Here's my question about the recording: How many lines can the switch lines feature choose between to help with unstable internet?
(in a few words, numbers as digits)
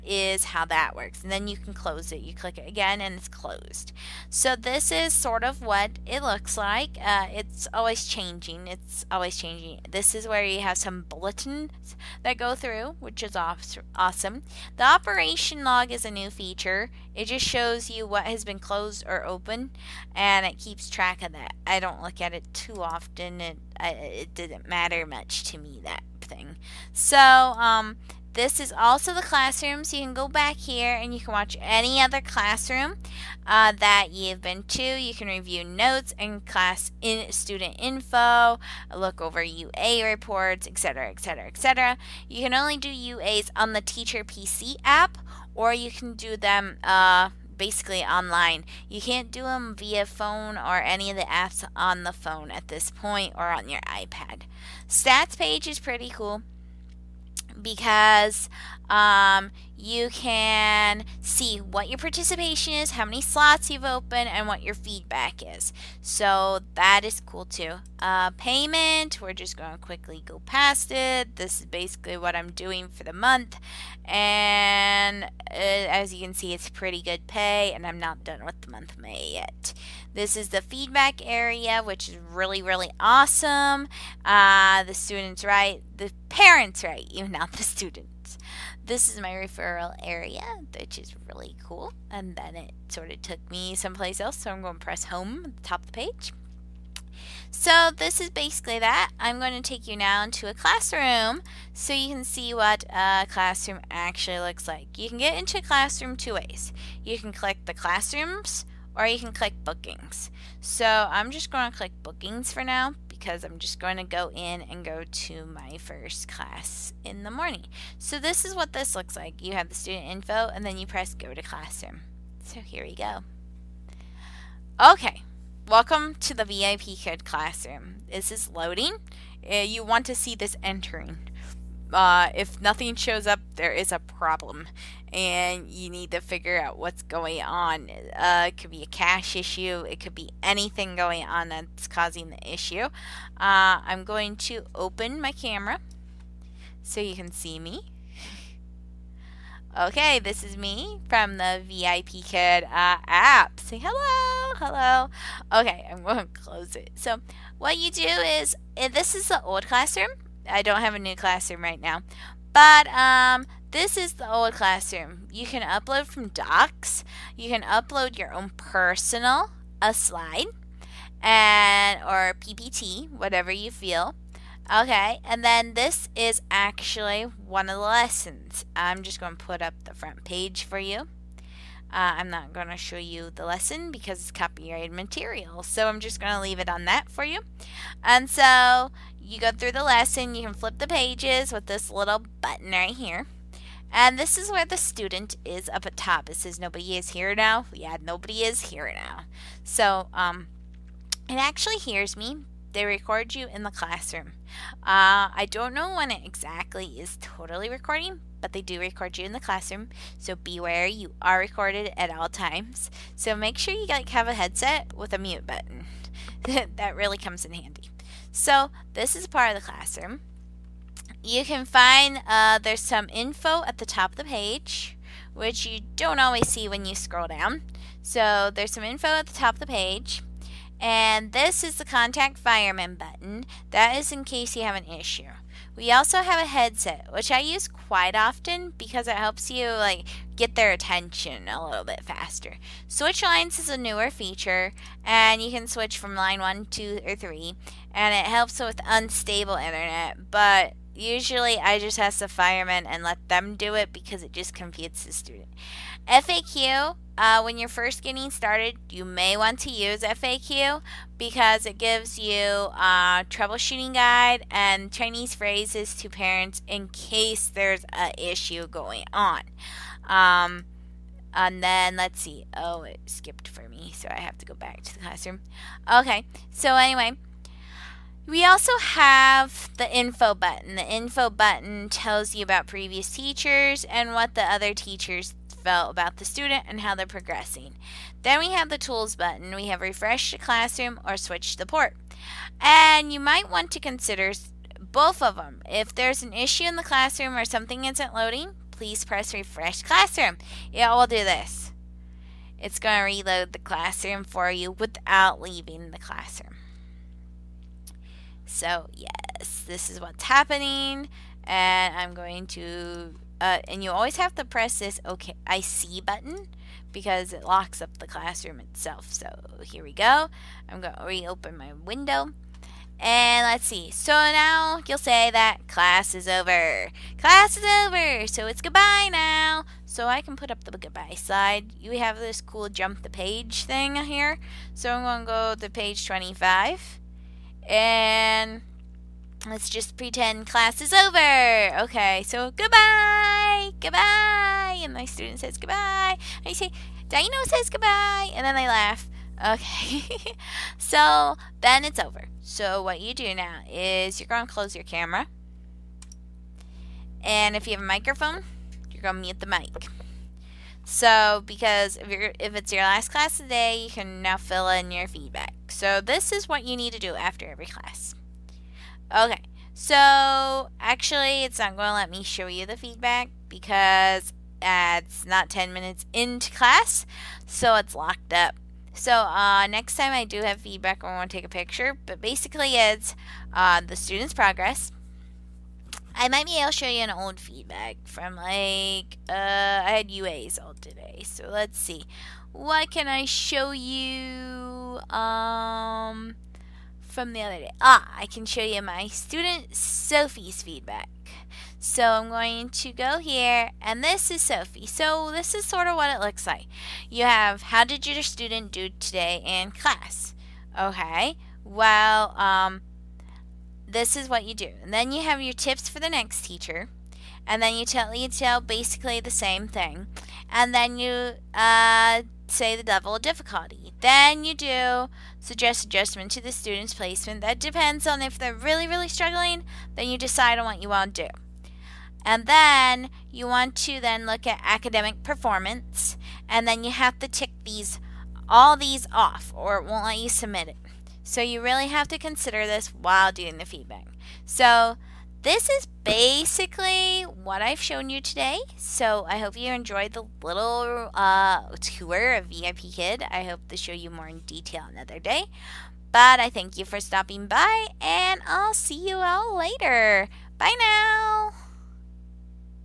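3.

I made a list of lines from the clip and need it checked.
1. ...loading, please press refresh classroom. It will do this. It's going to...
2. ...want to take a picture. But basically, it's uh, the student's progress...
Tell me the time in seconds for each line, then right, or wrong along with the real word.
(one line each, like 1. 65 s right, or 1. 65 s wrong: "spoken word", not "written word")
1. 298 s right
2. 381 s right.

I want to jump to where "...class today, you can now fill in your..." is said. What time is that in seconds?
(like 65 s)
363 s.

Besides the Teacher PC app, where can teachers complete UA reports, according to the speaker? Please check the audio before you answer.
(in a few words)
Online.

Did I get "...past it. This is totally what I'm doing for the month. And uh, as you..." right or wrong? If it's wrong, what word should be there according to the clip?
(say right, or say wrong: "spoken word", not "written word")
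wrong: "basically", not "totally".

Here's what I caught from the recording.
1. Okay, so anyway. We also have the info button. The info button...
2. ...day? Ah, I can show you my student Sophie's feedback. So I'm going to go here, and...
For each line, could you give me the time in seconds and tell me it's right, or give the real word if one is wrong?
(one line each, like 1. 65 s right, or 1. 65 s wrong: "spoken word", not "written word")
1. 275 s right
2. 397 s right.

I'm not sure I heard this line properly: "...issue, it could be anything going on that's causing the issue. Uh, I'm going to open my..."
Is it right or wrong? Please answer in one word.
right.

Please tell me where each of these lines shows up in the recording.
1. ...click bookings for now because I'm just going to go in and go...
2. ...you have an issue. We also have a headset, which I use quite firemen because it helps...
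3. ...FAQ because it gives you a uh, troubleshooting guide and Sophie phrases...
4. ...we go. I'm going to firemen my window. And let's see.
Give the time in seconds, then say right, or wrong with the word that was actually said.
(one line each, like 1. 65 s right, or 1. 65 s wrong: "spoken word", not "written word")
1. 111 s right
2. 234 s wrong: "often", not "firemen"
3. 260 s wrong: "Chinese", not "Sophie"
4. 319 s wrong: "reopen", not "firemen".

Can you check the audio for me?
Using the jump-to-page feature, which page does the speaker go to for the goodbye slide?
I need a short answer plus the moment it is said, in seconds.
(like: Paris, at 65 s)
25, at 336 s.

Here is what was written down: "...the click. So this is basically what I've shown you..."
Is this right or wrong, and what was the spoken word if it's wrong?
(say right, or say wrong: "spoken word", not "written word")
wrong: "feedback", not "click".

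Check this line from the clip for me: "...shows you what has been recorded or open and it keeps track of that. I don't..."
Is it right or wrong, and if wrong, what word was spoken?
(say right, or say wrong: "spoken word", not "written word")
wrong: "closed", not "recorded".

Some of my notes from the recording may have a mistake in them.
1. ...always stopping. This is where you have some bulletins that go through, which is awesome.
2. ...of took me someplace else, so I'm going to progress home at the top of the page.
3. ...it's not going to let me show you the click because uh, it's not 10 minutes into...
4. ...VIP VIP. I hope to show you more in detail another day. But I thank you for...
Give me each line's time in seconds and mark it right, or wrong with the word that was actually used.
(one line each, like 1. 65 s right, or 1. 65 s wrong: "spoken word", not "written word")
1. 9 s wrong: "changing", not "stopping"
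2. 93 s wrong: "press", not "progress"
3. 371 s wrong: "feedback", not "click"
4. 452 s wrong: "Kid", not "VIP".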